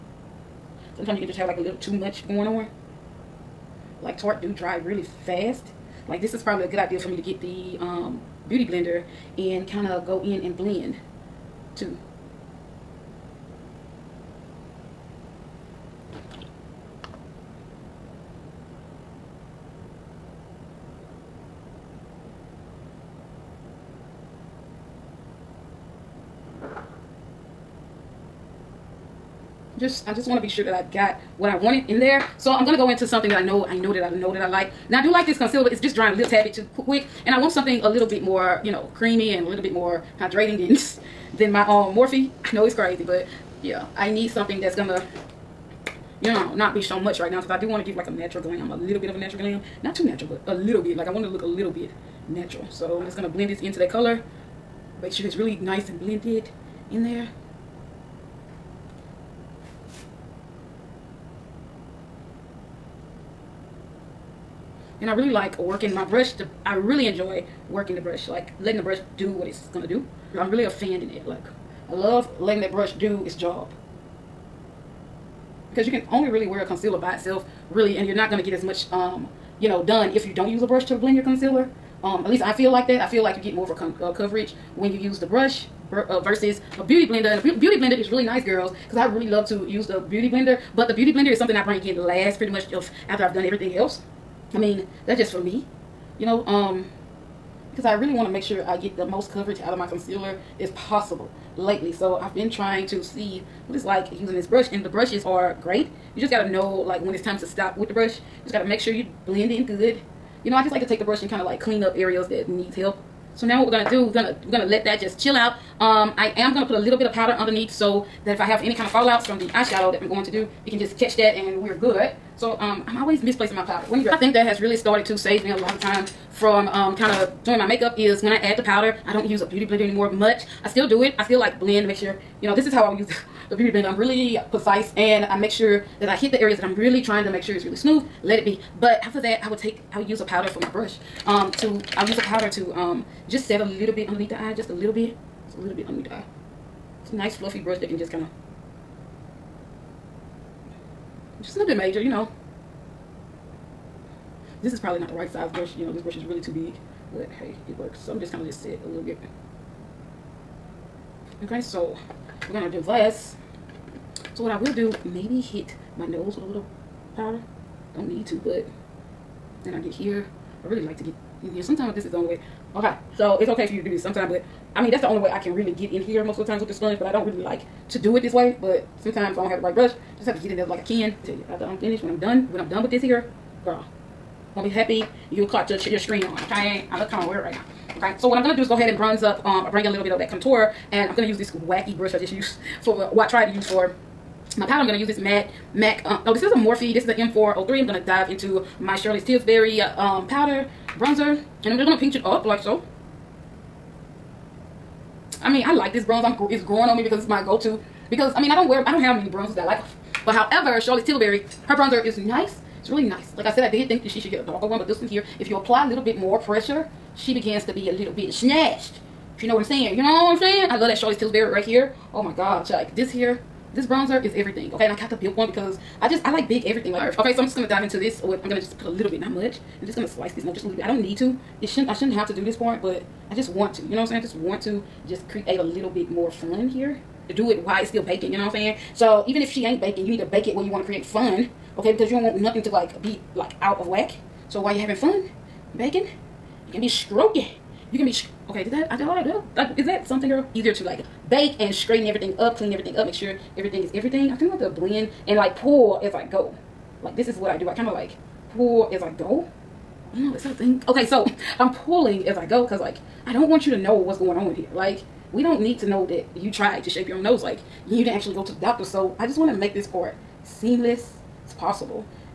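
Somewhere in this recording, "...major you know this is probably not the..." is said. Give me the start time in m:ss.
2:31.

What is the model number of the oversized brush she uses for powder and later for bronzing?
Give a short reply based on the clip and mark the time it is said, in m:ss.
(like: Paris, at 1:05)
M403, at 3:17.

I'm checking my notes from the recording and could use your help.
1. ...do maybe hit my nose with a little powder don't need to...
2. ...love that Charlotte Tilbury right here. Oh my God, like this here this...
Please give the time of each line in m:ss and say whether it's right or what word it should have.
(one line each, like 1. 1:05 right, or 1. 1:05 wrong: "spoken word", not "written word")
1. 2:44 right
2. 3:40 right.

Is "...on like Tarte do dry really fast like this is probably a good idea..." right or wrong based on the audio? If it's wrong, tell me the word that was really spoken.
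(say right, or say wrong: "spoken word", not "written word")
right.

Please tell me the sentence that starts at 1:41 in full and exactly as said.
So I've been trying to see what it's like using this brush and the brushes are great.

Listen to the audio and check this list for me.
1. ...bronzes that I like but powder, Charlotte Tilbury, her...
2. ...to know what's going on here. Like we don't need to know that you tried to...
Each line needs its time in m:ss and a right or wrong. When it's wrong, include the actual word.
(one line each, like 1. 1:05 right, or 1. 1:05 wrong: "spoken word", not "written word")
1. 3:29 wrong: "however", not "powder"
2. 4:23 right.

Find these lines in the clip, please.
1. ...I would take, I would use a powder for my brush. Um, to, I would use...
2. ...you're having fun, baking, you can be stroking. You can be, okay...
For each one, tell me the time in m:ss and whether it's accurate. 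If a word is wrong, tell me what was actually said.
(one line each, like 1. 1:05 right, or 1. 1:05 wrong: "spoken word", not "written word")
1. 2:19 right
2. 4:04 right.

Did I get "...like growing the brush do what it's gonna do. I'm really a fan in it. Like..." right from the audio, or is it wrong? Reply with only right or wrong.
wrong.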